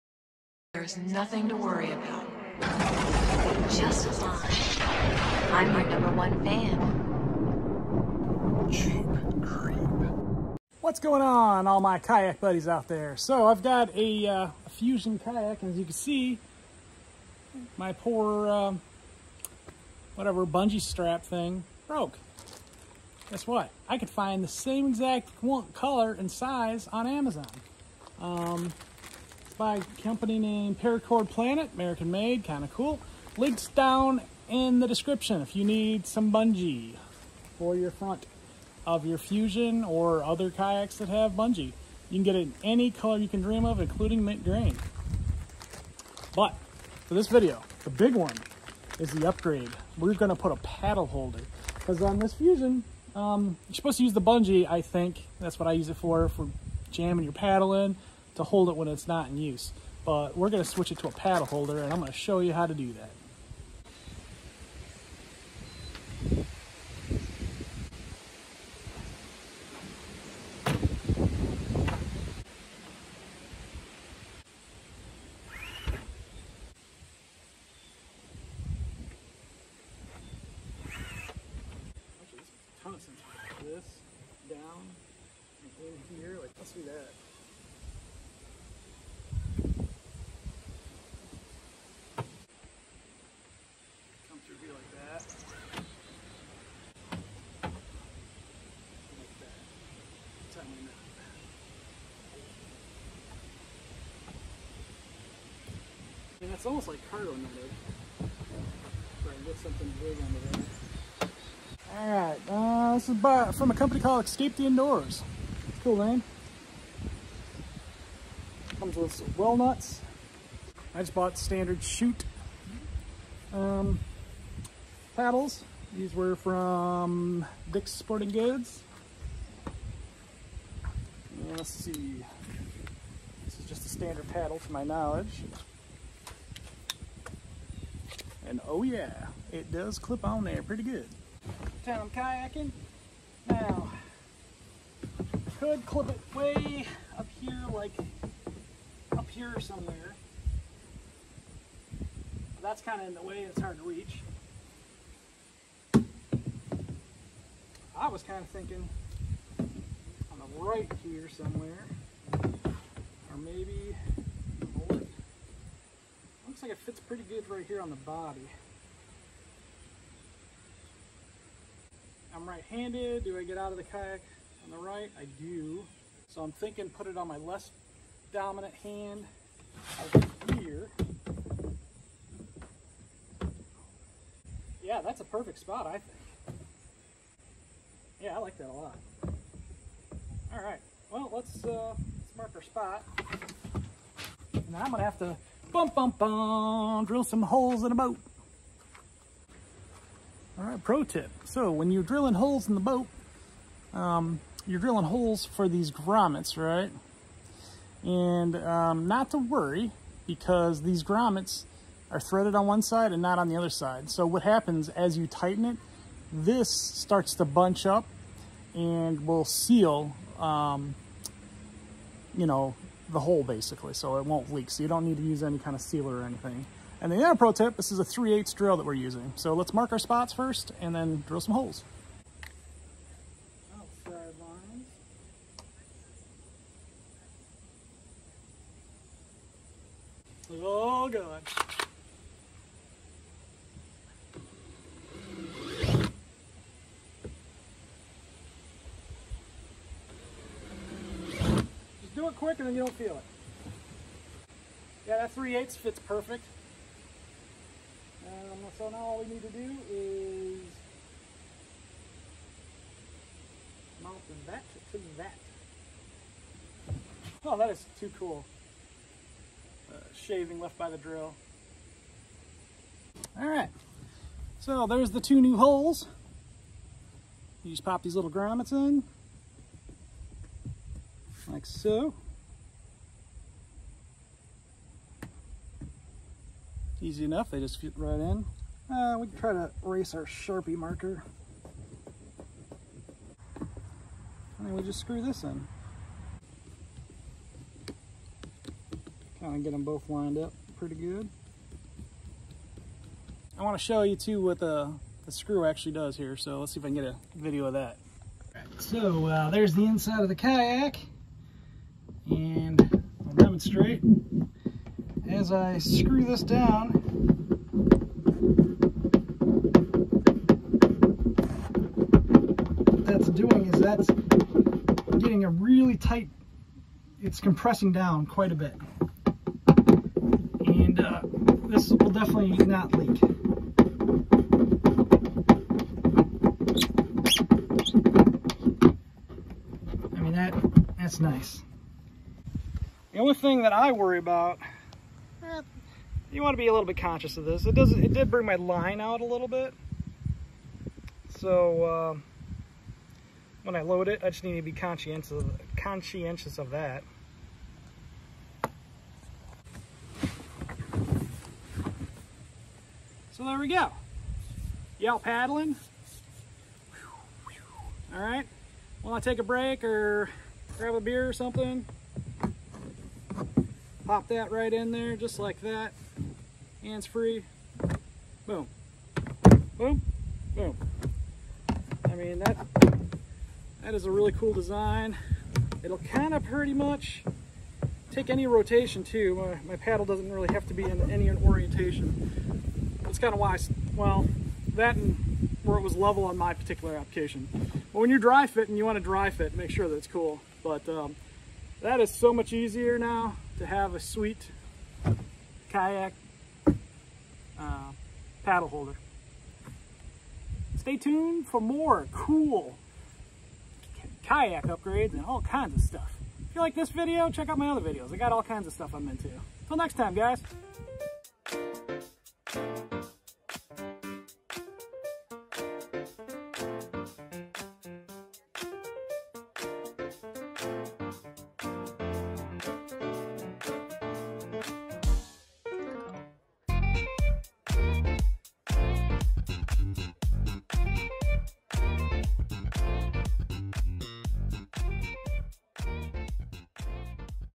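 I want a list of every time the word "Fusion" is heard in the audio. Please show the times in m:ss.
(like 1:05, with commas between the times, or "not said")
0:14, 0:39, 0:52.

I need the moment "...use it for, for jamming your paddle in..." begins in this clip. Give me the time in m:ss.
0:55.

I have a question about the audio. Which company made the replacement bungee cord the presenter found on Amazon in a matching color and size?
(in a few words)
Paracord Planet.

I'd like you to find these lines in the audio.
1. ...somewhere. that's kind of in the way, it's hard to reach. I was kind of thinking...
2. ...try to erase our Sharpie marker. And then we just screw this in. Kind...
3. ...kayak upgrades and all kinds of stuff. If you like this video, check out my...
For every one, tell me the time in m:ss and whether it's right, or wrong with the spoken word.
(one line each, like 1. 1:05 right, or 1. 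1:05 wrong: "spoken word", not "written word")
1. 2:29 right
2. 4:49 right
3. 6:54 right.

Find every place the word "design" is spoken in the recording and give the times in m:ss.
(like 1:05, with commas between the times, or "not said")
6:24.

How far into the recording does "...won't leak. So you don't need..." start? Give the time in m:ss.
3:44.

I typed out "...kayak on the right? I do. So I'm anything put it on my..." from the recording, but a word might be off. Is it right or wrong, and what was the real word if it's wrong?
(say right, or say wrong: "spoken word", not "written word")
wrong: "thinking", not "anything".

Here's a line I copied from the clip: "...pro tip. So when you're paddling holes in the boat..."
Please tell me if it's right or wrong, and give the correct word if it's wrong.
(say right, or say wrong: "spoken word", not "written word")
wrong: "drilling", not "paddling".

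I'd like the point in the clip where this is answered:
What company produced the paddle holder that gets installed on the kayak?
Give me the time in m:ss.
1:54.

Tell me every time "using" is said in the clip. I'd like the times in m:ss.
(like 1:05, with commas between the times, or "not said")
3:48.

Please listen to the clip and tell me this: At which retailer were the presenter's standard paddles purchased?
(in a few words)
Dick's Sporting Goods.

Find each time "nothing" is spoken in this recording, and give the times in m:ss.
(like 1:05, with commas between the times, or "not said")
0:00.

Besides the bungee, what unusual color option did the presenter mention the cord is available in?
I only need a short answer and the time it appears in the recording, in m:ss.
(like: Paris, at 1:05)
Mint green, at 0:44.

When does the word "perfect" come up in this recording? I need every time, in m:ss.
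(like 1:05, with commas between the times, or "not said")
3:05, 4:15.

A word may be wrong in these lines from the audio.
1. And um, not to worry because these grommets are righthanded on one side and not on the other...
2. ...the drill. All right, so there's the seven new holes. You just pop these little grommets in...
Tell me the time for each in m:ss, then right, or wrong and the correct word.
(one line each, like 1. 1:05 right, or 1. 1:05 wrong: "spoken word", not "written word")
1. 3:28 wrong: "threaded", not "righthanded"
2. 4:30 wrong: "two", not "seven".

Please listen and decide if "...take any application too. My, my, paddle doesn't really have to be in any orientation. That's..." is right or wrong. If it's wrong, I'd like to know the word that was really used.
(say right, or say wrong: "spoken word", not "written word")
wrong: "rotation", not "application".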